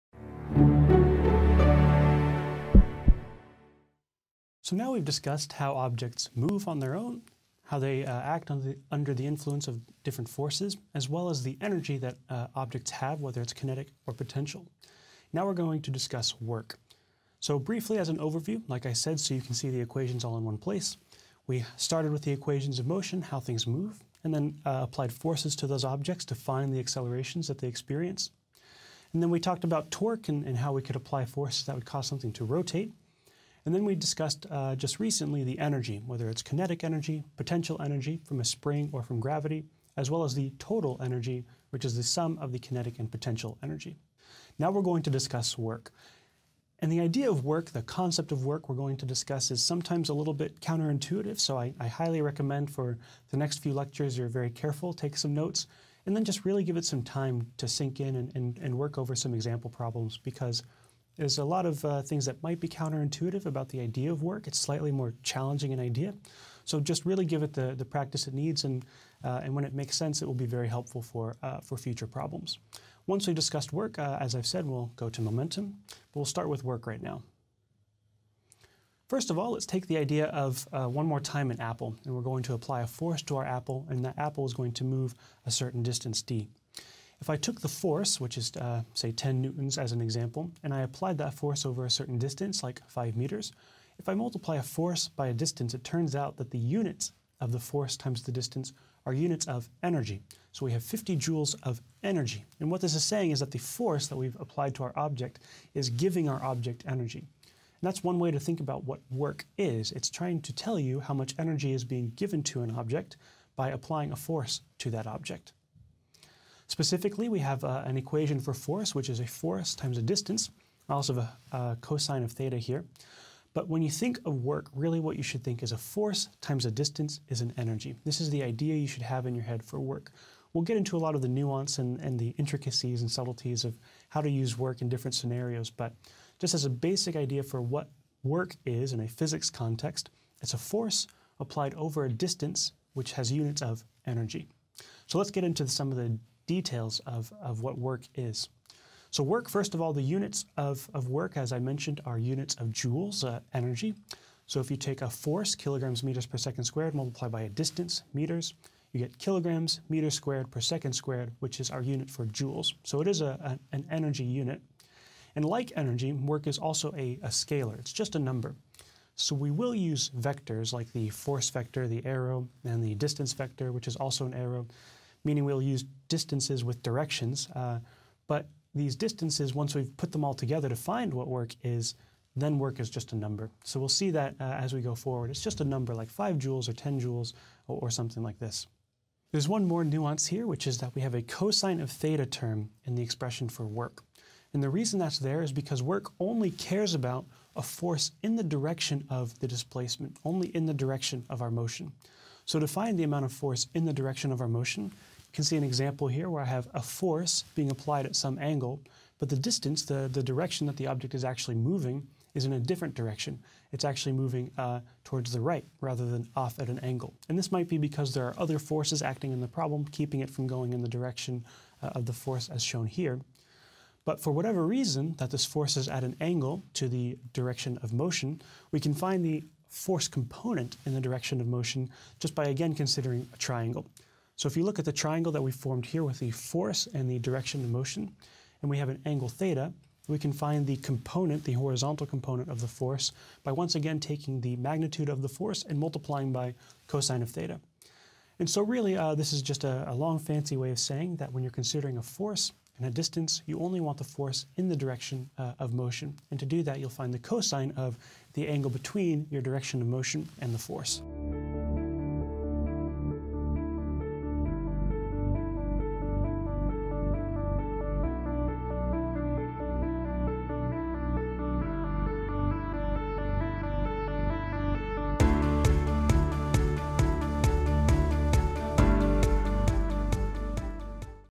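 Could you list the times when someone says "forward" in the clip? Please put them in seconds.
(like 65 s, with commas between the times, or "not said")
184 s.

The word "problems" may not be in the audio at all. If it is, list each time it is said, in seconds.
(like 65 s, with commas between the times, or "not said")
59 s, 72 s, 219 s.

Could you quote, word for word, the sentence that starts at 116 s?
Specifically, we have uh, an equation for force, which is a force times a distance.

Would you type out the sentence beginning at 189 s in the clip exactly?
There's one more nuance here, which is that we have a cosine of theta term in the expression for work.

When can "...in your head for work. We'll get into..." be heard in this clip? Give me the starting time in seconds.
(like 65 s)
129 s.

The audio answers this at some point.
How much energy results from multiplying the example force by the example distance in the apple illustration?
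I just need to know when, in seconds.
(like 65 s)
100 s.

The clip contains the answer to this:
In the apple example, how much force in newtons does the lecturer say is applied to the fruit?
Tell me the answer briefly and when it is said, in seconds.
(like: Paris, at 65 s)
10 newtons, at 89 s.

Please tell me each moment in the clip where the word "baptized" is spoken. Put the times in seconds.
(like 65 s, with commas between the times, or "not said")
not said.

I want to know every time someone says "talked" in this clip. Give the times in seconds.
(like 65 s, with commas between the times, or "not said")
29 s.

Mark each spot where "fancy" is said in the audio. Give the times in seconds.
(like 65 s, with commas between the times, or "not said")
250 s.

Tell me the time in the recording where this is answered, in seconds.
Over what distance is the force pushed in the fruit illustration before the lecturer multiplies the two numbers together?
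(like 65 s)
92 s.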